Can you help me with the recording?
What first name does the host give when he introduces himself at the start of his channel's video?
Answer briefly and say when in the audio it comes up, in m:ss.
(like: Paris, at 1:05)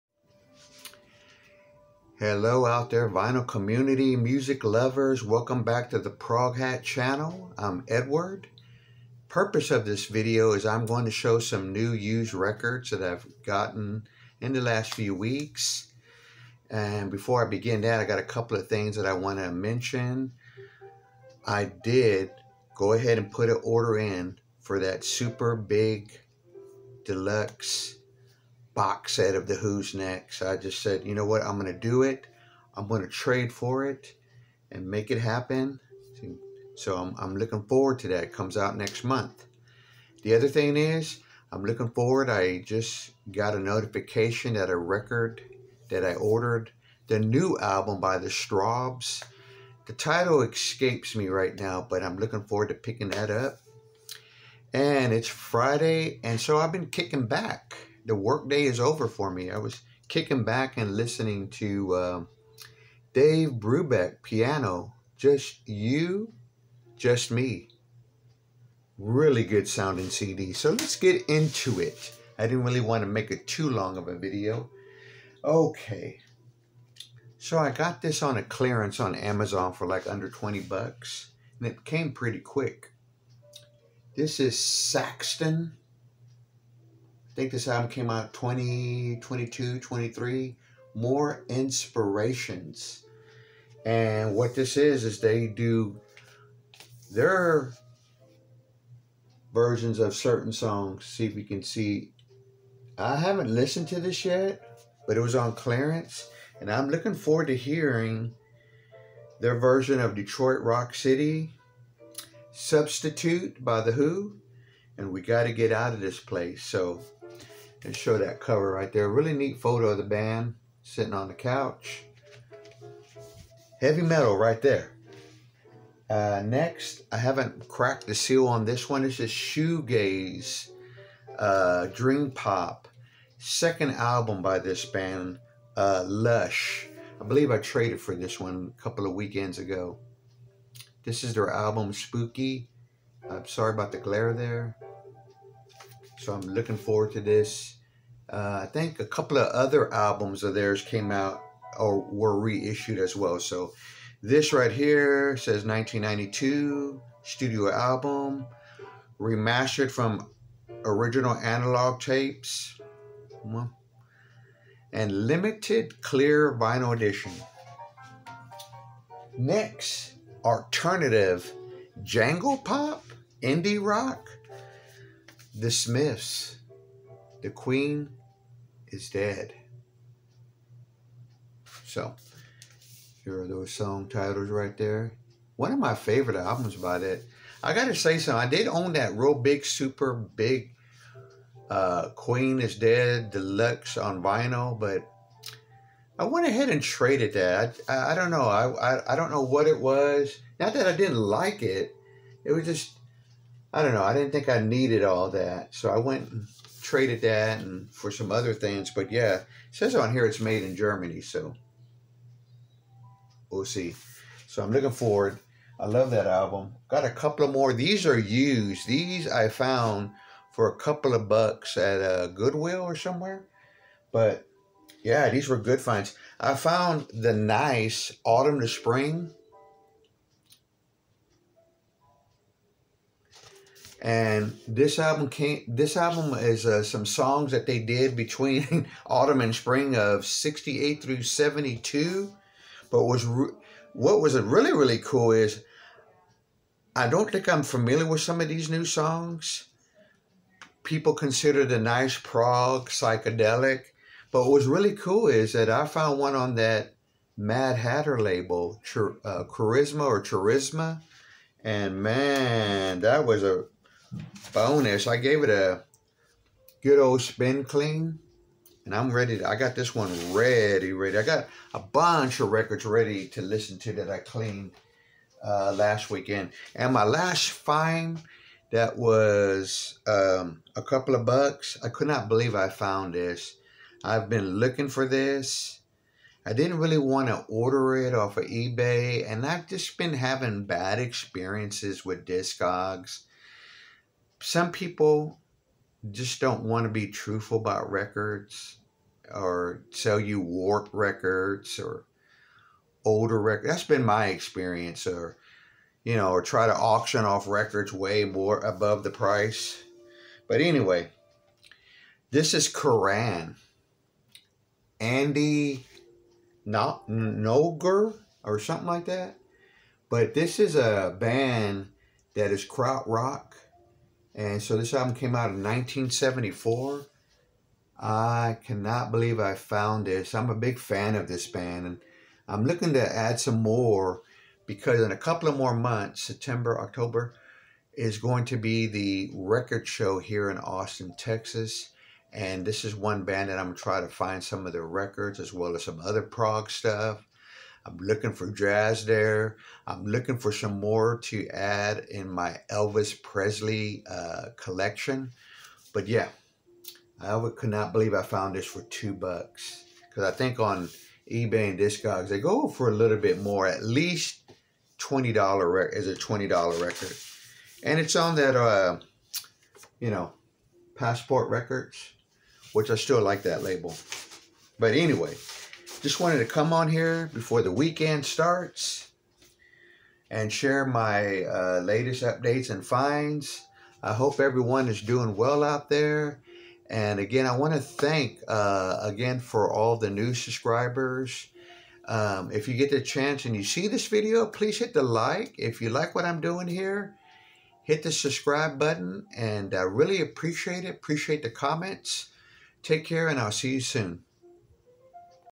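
Edward, at 0:07.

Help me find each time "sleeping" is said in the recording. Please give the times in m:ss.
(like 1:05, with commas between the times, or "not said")
not said.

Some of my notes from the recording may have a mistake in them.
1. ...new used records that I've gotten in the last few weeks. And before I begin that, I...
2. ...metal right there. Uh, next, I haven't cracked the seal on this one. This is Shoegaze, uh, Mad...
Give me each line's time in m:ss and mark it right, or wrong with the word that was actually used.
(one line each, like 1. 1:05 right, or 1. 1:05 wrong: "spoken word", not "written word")
1. 0:11 right
2. 2:04 wrong: "Dream", not "Mad".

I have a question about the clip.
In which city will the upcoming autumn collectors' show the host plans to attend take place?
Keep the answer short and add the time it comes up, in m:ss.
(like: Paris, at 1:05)
Austin, Texas, at 5:40.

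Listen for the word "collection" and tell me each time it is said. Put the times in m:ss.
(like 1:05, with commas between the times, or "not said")
5:54.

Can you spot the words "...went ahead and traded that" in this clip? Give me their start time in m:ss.
3:16.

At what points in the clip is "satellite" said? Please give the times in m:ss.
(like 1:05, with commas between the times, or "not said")
not said.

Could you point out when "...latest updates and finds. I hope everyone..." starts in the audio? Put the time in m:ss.
6:21.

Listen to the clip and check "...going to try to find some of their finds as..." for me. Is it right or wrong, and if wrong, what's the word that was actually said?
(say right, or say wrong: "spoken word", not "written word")
wrong: "records", not "finds".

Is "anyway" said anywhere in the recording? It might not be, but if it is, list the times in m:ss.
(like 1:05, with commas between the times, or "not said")
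5:10, 6:14.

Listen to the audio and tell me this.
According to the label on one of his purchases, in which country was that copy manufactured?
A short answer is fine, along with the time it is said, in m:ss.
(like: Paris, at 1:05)
Germany, at 3:30.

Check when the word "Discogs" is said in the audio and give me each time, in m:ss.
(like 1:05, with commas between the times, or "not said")
4:52, 6:01.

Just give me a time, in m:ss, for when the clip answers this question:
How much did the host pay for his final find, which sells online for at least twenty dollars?
5:58.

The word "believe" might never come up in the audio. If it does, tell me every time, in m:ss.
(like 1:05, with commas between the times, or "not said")
2:17, 4:42, 5:29, 5:57.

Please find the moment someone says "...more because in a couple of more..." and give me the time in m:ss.
5:33.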